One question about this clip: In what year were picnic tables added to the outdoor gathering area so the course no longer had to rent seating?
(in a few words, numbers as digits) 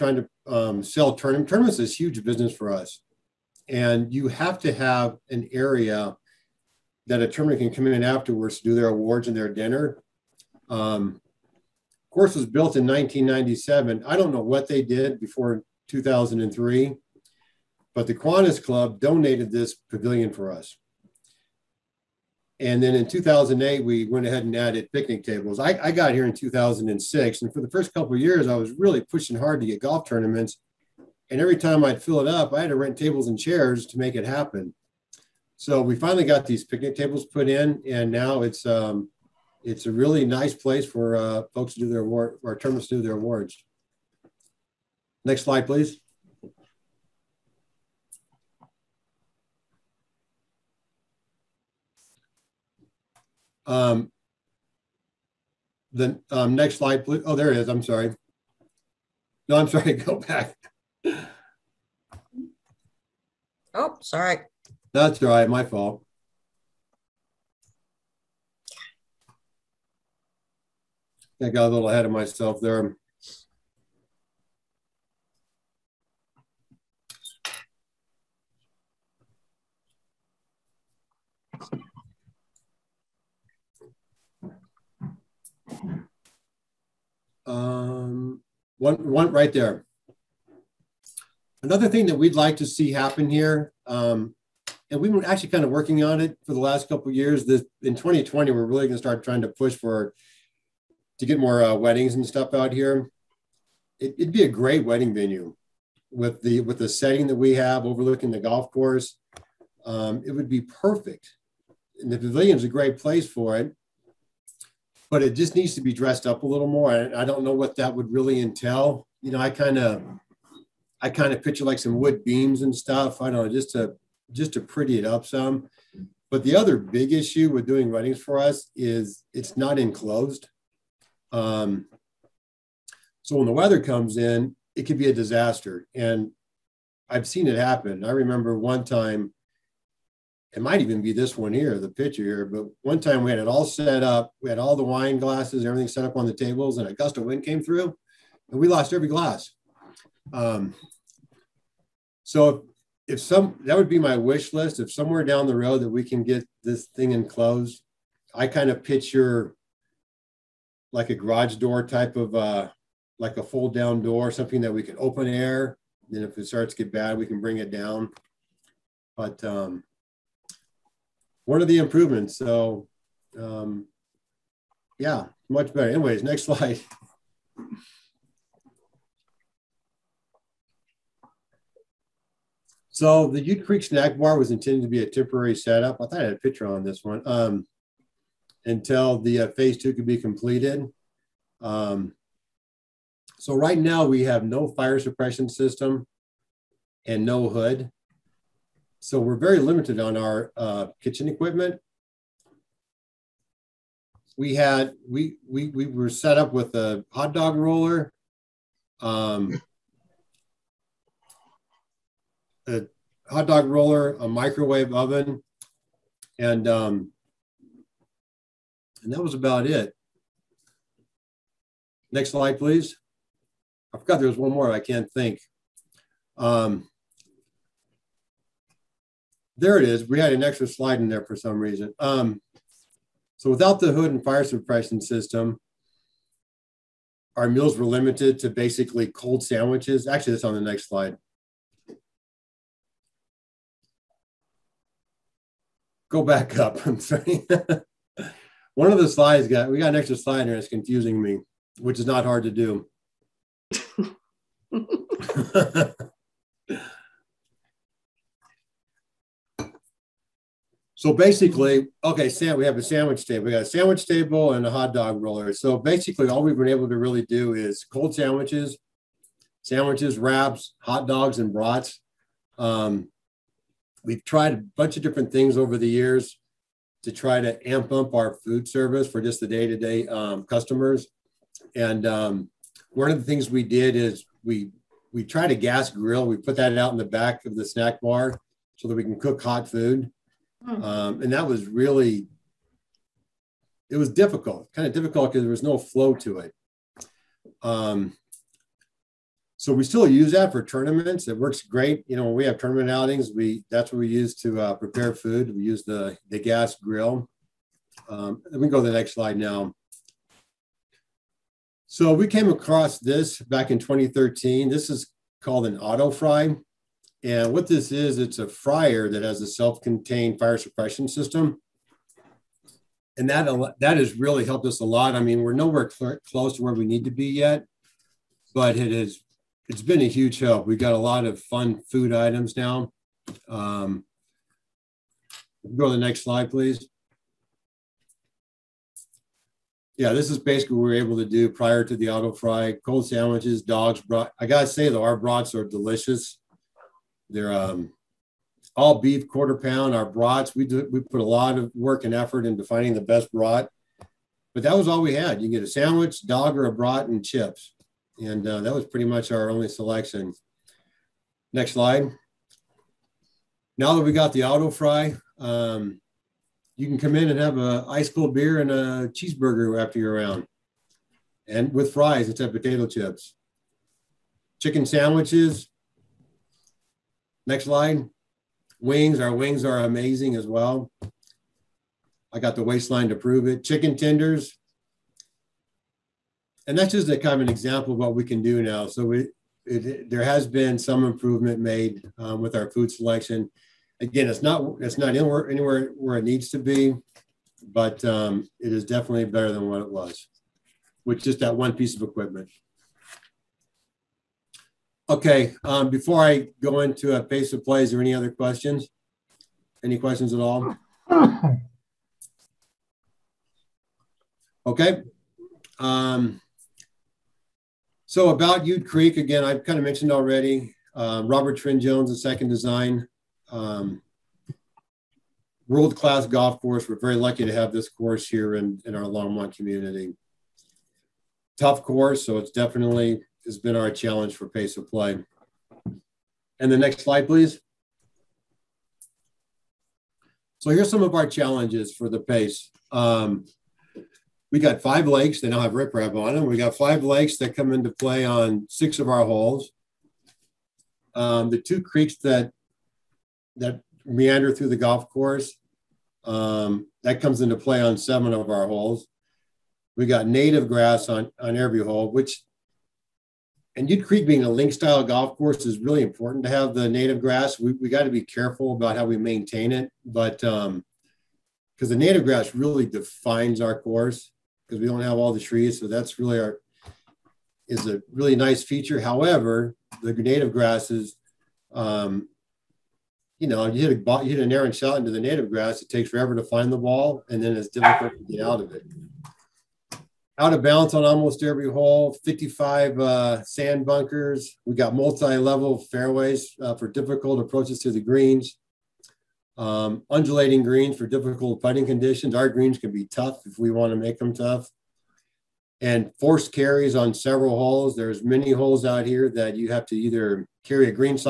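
2008.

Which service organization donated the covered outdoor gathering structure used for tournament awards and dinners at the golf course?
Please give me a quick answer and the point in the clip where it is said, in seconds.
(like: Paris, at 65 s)
Kiwanis Club, at 18 s.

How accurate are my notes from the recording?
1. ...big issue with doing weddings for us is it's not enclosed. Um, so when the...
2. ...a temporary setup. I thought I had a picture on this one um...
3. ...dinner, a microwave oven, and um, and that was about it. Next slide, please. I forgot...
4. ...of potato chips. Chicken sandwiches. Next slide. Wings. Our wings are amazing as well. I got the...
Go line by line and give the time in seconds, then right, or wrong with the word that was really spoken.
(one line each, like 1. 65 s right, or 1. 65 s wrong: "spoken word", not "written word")
1. 126 s right
2. 185 s right
3. 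213 s wrong: "roller", not "dinner"
4. 372 s right.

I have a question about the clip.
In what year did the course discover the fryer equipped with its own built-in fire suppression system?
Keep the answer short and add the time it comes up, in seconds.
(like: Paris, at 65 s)
2013, at 313 s.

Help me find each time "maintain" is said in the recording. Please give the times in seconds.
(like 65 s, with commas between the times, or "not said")
469 s.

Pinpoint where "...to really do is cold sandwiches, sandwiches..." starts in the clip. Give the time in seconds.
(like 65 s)
266 s.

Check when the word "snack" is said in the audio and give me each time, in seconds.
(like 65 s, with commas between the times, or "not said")
183 s, 287 s.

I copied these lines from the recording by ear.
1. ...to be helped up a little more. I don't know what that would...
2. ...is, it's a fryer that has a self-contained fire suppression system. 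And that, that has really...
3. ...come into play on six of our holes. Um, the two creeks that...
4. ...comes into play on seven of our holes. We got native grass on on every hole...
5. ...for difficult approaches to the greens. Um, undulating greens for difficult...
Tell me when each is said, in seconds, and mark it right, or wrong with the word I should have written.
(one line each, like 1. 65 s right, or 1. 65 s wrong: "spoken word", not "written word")
1. 115 s wrong: "dressed", not "helped"
2. 317 s right
3. 447 s right
4. 457 s right
5. 496 s right.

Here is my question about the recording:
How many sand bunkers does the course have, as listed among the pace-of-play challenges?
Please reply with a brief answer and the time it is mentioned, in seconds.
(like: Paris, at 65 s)
55, at 492 s.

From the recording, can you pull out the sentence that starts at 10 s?
Um, course was built in 1997.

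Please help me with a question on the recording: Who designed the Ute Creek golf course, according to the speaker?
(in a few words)
Robert Trent Jones.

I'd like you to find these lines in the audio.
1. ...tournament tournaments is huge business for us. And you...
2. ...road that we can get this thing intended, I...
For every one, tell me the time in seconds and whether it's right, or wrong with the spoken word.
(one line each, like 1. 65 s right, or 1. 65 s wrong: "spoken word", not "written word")
1. 1 s right
2. 155 s wrong: "enclosed", not "intended".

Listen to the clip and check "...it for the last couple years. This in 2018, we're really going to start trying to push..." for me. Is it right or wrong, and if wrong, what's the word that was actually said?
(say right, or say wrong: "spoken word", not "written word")
wrong: "2020", not "2018".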